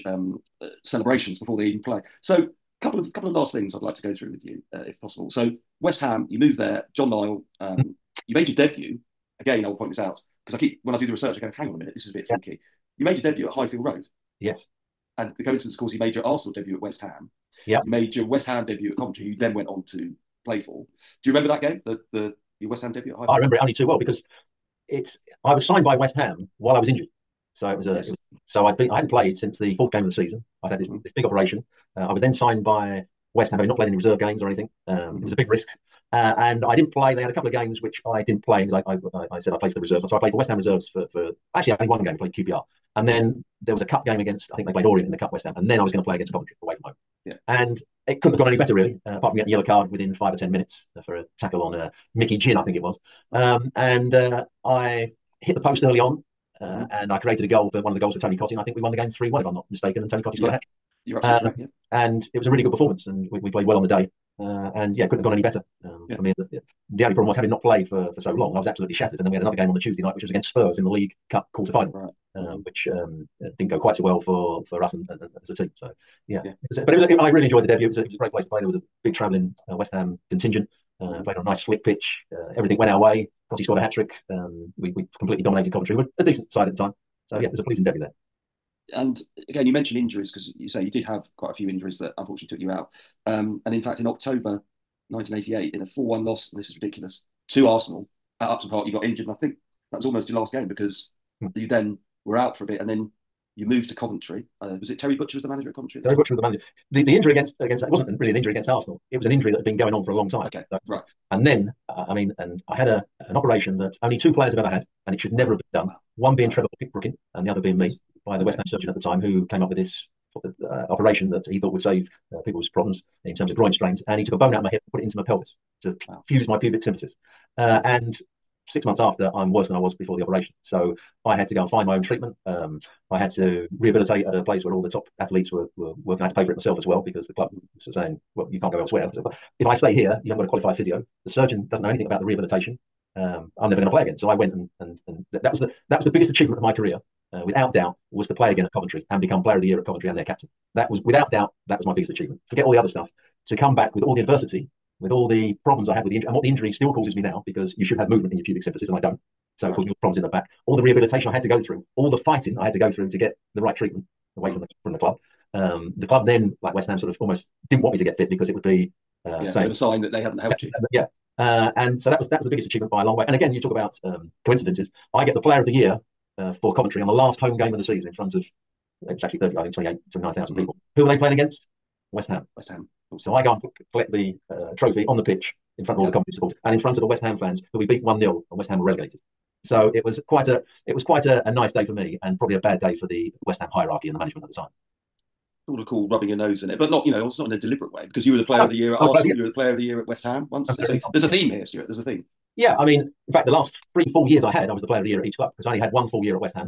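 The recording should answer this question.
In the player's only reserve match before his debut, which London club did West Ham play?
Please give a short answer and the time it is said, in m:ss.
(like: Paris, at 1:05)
QPR, at 0:42.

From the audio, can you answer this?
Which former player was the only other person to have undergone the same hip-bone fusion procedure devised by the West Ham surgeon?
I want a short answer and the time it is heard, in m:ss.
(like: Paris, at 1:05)
Trevor Brooking, at 1:56.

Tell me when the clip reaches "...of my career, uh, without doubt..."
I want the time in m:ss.
2:26.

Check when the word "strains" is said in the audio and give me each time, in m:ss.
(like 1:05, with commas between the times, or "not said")
2:03.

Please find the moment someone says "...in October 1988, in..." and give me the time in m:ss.
1:33.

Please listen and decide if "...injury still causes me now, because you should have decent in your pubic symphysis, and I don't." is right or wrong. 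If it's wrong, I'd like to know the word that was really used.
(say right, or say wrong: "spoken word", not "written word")
wrong: "movement", not "decent".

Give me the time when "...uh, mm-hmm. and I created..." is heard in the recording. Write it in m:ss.
0:56.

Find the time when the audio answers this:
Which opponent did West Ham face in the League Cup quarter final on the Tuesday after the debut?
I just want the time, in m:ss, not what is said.
1:10.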